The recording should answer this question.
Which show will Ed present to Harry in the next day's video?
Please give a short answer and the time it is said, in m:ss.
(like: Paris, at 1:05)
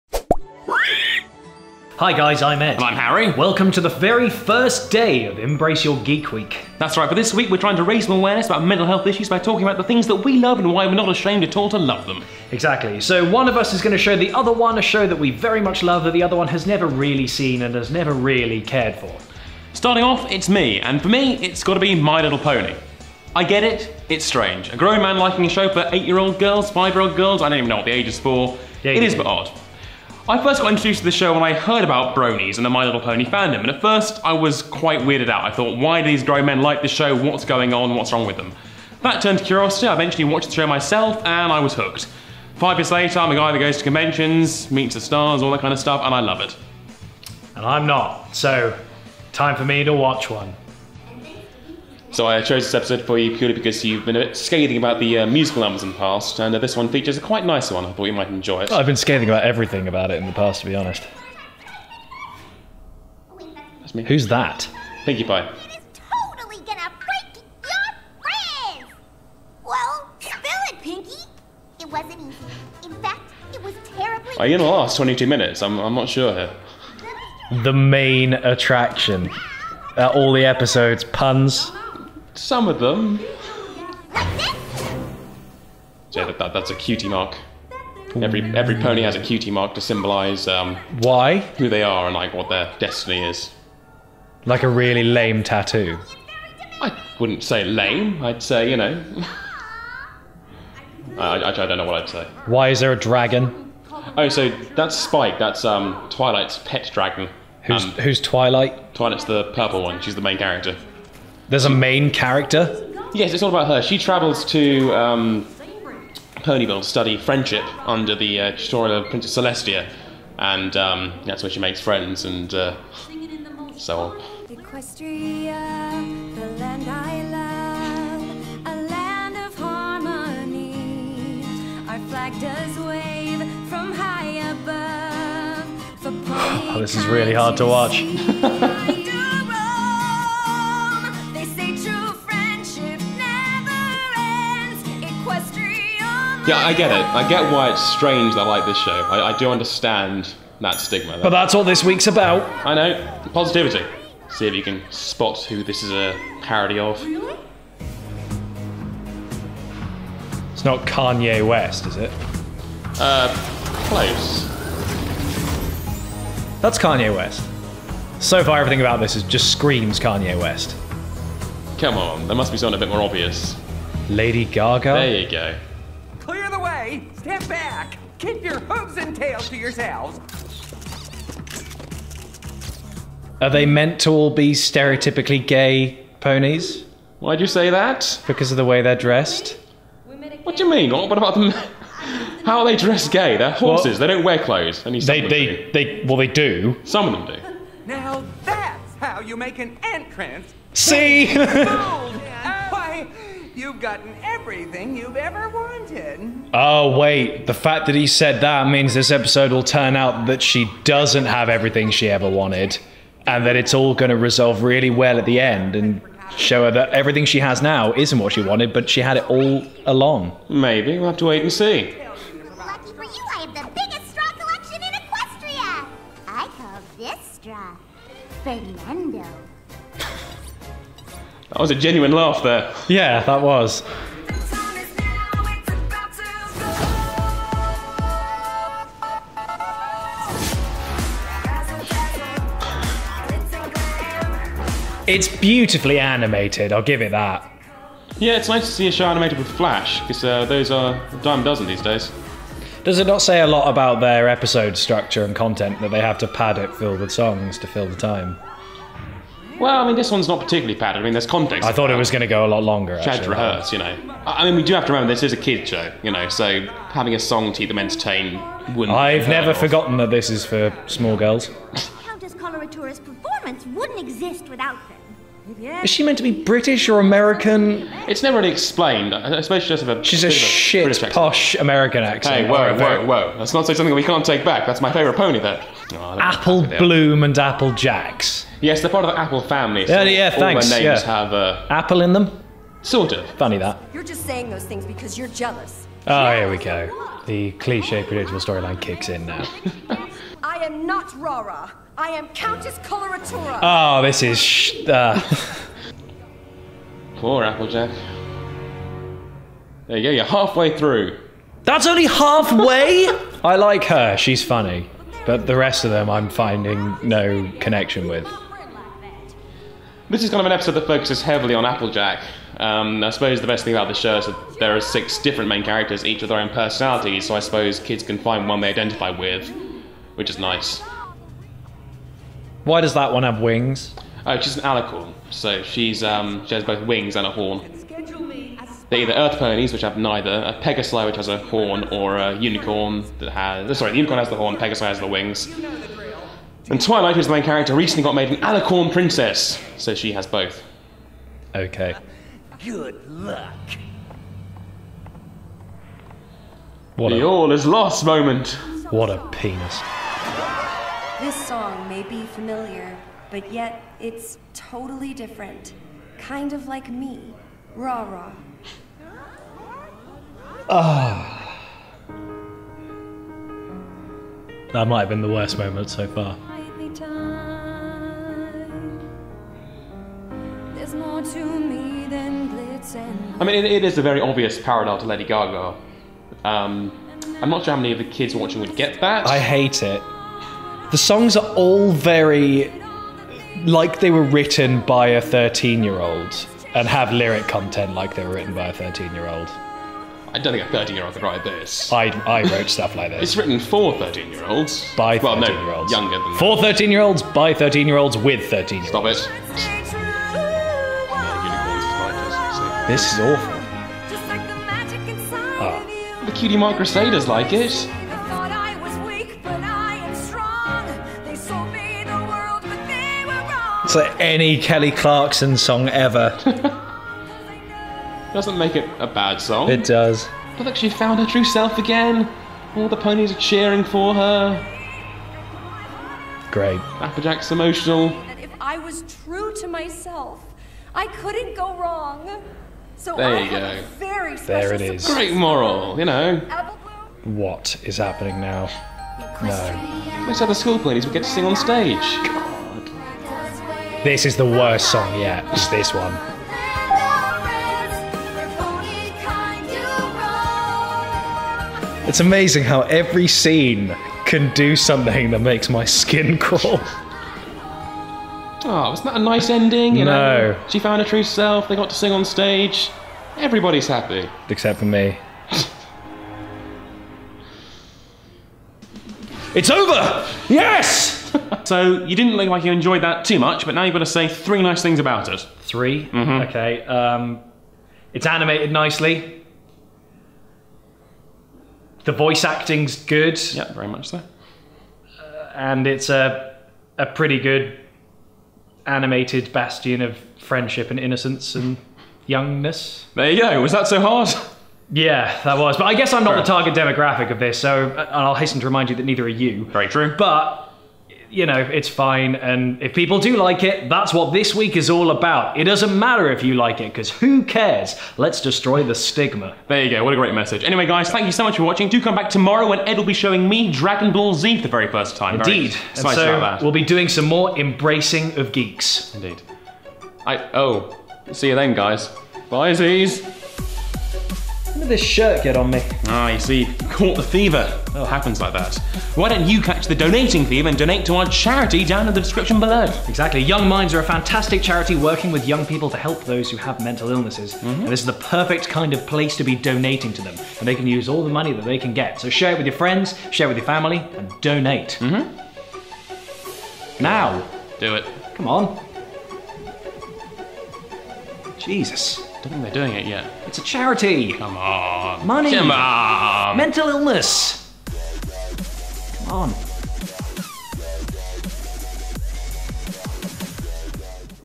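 Dragon Ball Z, at 8:43.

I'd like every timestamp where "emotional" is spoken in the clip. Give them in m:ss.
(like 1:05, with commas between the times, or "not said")
7:17.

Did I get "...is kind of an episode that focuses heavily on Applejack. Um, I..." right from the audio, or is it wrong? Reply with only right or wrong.
right.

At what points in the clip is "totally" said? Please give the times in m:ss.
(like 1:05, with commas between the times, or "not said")
1:06, 6:04.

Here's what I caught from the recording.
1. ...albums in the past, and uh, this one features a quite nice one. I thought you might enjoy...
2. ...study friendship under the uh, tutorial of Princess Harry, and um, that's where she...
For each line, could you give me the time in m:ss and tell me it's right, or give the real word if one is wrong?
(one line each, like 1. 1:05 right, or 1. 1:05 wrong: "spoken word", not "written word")
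1. 0:55 right
2. 1:56 wrong: "Celestia", not "Harry".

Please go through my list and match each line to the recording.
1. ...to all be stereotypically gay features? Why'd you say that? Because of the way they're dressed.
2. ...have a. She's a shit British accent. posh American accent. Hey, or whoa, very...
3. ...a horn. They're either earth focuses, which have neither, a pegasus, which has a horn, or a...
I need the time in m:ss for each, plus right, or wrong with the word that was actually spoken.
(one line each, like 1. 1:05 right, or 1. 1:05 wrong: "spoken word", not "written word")
1. 3:04 wrong: "ponies", not "features"
2. 4:39 right
3. 5:37 wrong: "ponies", not "focuses".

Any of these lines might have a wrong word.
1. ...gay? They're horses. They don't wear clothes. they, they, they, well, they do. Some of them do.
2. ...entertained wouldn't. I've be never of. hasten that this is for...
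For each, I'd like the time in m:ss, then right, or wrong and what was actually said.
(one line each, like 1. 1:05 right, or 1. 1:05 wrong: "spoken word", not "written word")
1. 3:13 right
2. 4:27 wrong: "forgotten", not "hasten".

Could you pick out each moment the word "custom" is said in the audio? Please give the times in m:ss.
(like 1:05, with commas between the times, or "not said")
not said.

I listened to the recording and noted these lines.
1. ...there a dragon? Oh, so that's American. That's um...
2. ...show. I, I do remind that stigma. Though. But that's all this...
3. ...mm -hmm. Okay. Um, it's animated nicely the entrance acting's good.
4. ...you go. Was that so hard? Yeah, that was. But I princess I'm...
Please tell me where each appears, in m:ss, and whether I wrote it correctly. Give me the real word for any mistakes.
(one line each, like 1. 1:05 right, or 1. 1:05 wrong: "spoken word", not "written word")
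1. 1:42 wrong: "Spike", not "American"
2. 2:28 wrong: "understand", not "remind"
3. 8:06 wrong: "voice", not "entrance"
4. 8:23 wrong: "guess", not "princess".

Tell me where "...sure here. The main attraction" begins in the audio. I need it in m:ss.
1:16.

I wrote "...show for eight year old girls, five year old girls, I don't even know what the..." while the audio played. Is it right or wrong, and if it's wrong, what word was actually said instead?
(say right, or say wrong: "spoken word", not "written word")
right.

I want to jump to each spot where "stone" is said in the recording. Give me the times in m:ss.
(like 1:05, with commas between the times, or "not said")
not said.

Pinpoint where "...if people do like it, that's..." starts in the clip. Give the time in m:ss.
8:32.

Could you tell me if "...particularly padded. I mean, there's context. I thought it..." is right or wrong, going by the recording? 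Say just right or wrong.
right.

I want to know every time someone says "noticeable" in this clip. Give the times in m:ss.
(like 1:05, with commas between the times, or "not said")
not said.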